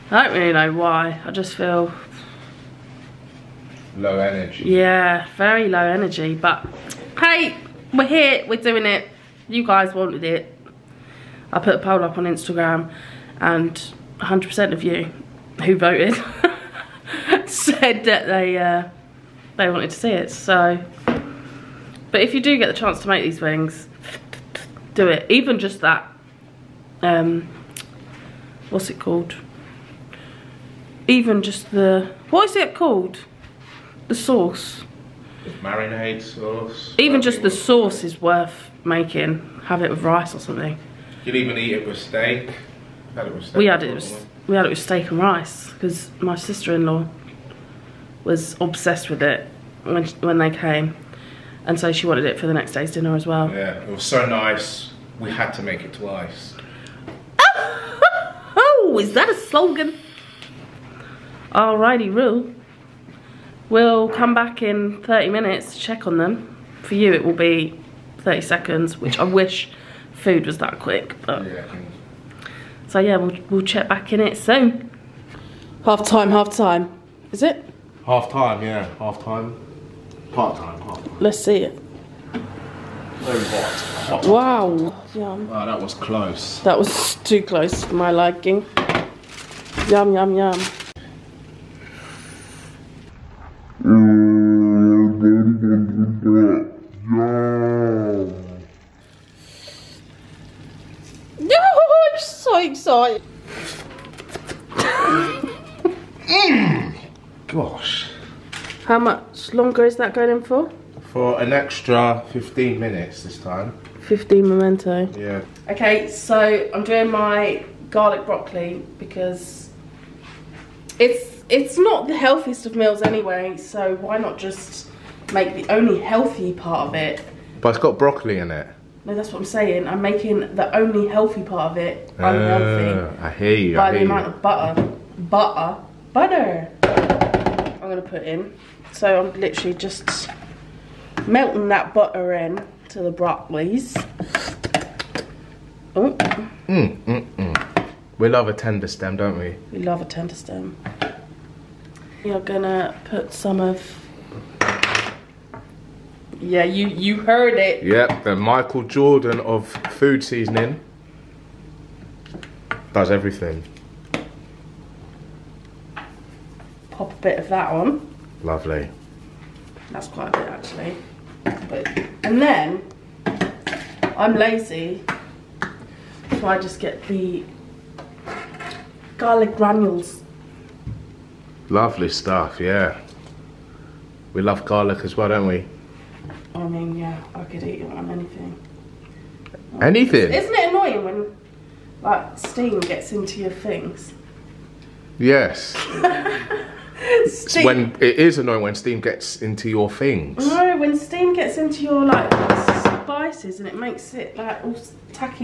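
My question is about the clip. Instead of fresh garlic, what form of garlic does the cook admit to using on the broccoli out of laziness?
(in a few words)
garlic granules.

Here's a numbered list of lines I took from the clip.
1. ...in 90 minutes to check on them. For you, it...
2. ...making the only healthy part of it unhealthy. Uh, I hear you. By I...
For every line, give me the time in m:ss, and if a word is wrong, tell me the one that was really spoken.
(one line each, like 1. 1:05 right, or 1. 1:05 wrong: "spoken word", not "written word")
1. 1:04 wrong: "30", not "90"
2. 2:10 right.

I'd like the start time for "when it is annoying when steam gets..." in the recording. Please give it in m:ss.
3:17.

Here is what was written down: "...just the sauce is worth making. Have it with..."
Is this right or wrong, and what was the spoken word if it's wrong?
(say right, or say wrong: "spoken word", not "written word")
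right.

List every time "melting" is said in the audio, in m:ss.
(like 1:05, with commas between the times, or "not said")
2:21.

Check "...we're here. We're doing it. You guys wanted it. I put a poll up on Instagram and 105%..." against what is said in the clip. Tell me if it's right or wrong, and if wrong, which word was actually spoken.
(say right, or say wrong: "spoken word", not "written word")
wrong: "100", not "105".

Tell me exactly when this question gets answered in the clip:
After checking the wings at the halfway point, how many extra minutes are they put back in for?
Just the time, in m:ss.
1:52.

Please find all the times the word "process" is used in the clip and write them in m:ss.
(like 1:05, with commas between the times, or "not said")
not said.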